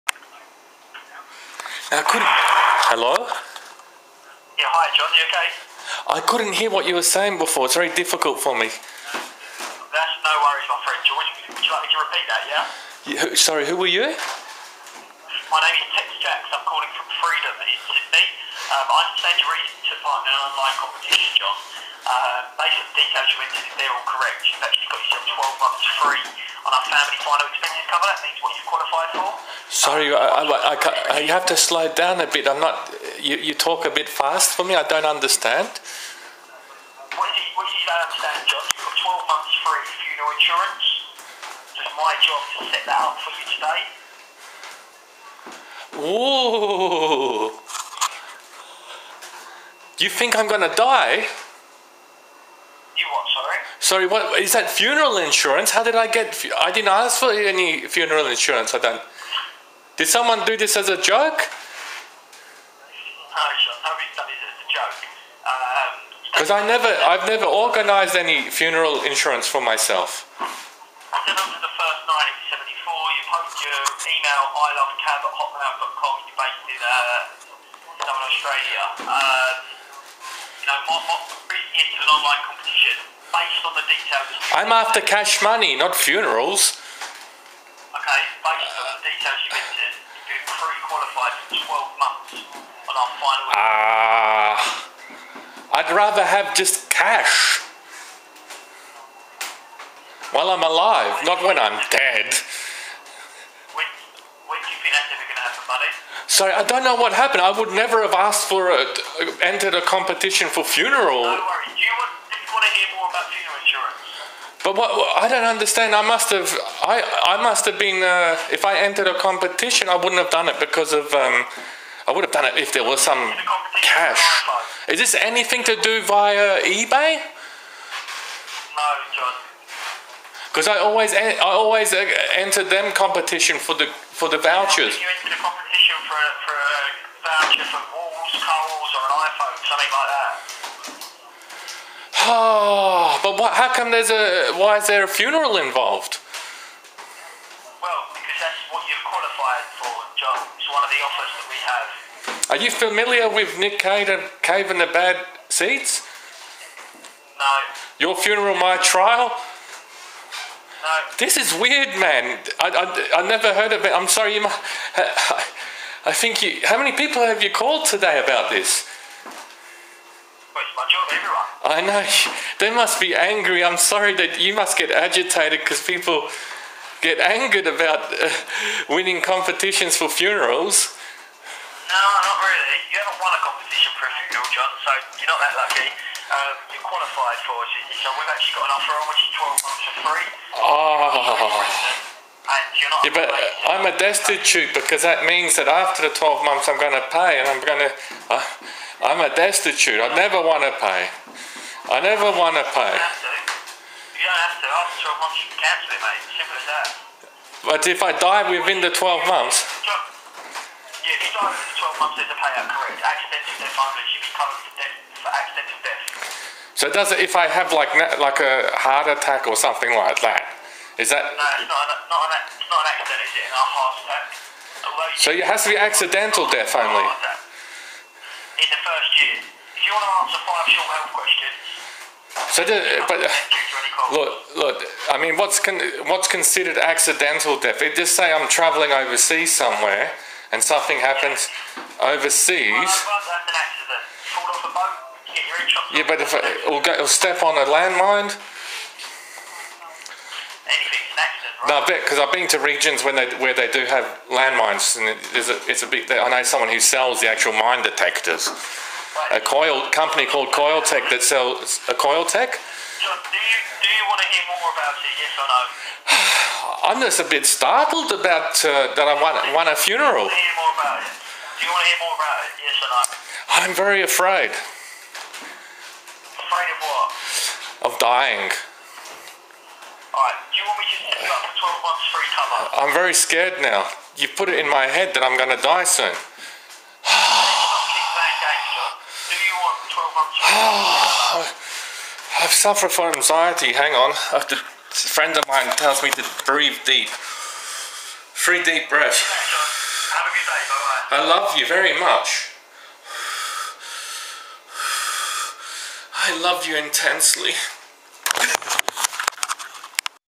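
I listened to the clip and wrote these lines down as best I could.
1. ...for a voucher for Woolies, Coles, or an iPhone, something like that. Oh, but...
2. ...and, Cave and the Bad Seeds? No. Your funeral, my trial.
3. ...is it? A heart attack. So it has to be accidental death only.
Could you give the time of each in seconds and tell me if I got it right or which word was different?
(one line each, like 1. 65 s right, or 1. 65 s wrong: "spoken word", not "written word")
1. 136 s right
2. 154 s right
3. 223 s right.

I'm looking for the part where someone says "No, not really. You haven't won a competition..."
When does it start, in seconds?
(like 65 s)
181 s.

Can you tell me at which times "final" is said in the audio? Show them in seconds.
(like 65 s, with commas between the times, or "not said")
27 s, 93 s.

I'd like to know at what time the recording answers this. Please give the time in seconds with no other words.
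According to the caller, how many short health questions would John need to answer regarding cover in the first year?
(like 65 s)
230 s.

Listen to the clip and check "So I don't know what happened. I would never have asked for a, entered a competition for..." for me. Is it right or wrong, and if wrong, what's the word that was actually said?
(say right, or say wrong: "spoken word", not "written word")
right.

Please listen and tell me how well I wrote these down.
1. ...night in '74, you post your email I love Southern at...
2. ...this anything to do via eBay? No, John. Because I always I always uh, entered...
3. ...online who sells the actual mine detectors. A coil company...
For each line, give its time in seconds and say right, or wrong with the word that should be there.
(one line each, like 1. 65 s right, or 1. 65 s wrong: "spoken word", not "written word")
1. 72 s wrong: "Cab", not "Southern"
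2. 124 s right
3. 256 s wrong: "someone", not "online".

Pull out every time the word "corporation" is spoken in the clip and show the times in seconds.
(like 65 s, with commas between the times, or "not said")
not said.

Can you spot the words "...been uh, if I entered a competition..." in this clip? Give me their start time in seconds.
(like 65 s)
117 s.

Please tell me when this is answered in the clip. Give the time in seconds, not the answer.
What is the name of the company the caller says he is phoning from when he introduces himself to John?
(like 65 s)
17 s.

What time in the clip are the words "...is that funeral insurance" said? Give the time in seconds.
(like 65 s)
54 s.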